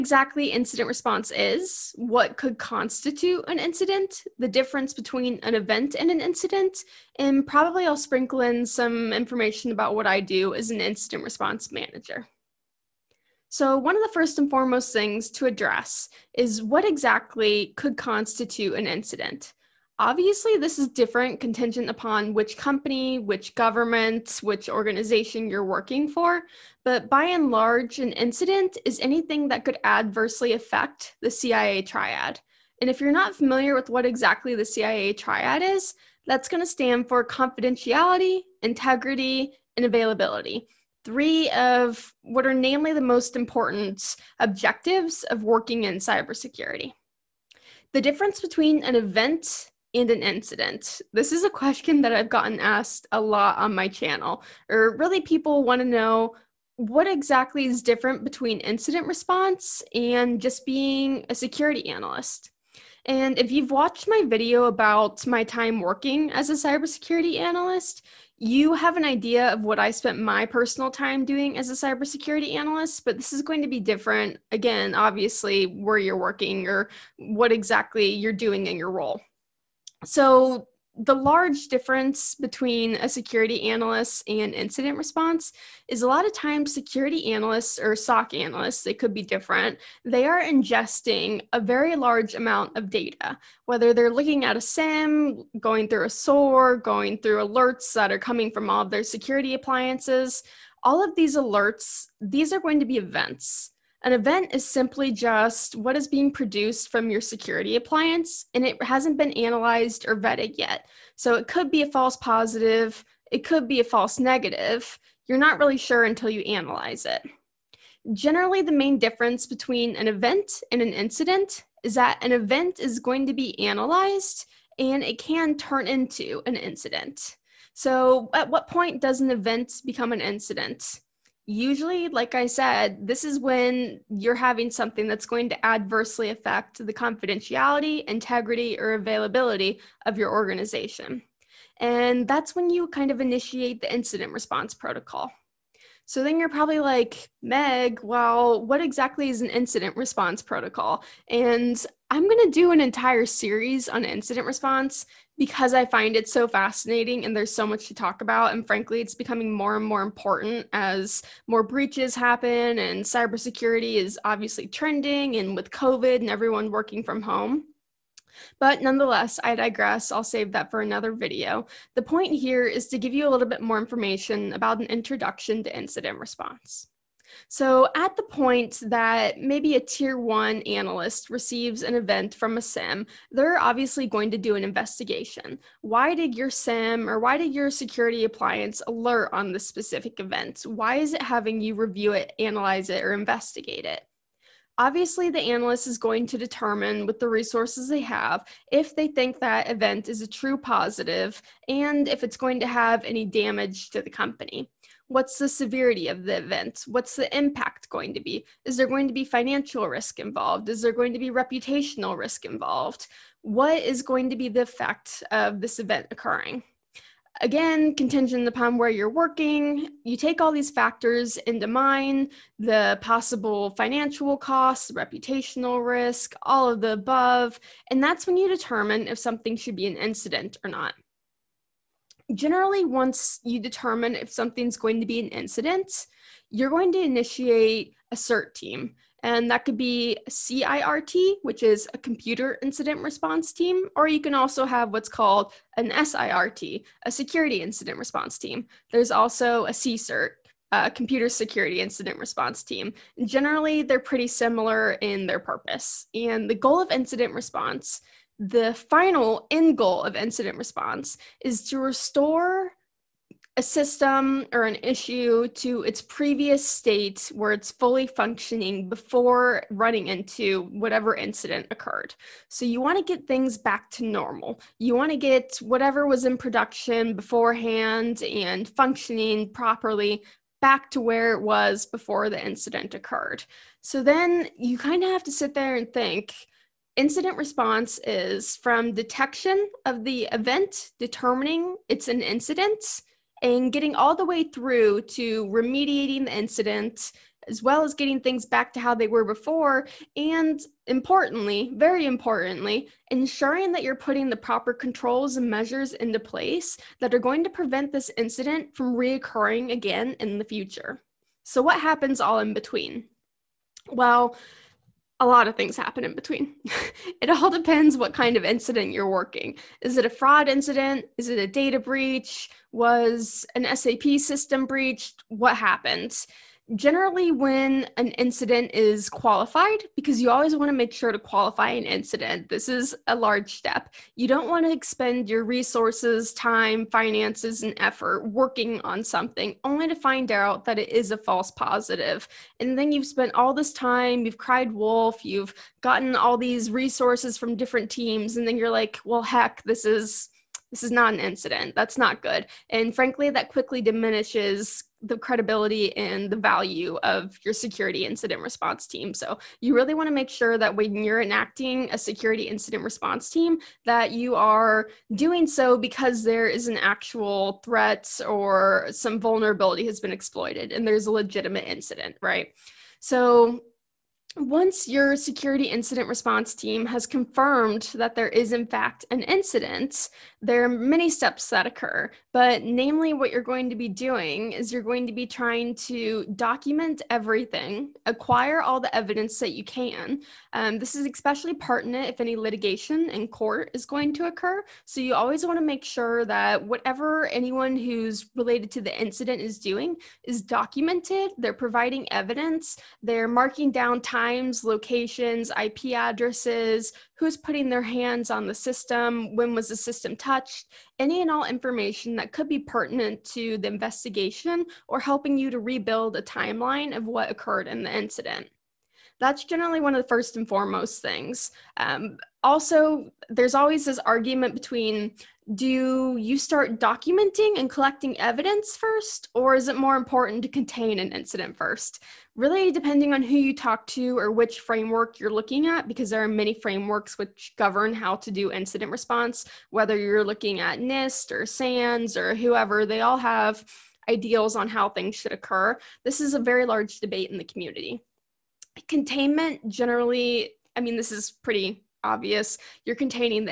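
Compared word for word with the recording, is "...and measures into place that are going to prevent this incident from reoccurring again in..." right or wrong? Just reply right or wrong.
right.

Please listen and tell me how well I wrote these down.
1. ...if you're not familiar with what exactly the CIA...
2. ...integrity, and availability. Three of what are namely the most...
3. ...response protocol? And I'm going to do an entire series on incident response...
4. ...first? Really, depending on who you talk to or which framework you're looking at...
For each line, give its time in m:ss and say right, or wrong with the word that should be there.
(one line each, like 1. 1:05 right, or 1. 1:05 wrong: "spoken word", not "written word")
1. 0:32 right
2. 0:38 right
3. 2:29 right
4. 7:11 right.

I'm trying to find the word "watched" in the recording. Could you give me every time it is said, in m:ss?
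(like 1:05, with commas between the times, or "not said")
1:03.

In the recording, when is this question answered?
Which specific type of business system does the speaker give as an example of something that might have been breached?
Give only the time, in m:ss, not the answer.
5:23.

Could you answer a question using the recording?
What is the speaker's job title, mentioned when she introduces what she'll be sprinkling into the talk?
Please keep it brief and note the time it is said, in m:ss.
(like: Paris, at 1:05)
incident response manager, at 0:10.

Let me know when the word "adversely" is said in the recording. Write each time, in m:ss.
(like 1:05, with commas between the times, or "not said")
0:29, 2:15.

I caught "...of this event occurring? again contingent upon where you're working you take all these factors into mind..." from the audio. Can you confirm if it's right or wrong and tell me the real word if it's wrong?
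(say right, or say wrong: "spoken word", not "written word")
right.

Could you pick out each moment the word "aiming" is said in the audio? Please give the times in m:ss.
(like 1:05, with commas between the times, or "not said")
not said.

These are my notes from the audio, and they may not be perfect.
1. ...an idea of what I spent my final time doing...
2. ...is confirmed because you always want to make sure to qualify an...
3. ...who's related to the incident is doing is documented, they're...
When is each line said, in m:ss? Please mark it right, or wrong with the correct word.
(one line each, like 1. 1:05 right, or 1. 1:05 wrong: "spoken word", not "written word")
1. 1:08 wrong: "personal", not "final"
2. 5:28 wrong: "qualified", not "confirmed"
3. 6:37 right.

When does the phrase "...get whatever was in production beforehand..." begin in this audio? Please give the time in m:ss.
4:35.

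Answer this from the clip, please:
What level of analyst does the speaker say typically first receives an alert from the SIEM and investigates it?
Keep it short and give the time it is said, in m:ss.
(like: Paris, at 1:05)
tier one analyst, at 2:59.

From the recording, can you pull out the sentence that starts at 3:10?
Why is it having you review it, analyze it, or investigate it?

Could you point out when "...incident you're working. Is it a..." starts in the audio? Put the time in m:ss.
5:18.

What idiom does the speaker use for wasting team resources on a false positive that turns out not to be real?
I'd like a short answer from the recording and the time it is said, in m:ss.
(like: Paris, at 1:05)
cried wolf, at 5:44.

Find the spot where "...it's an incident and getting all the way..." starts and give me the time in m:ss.
4:51.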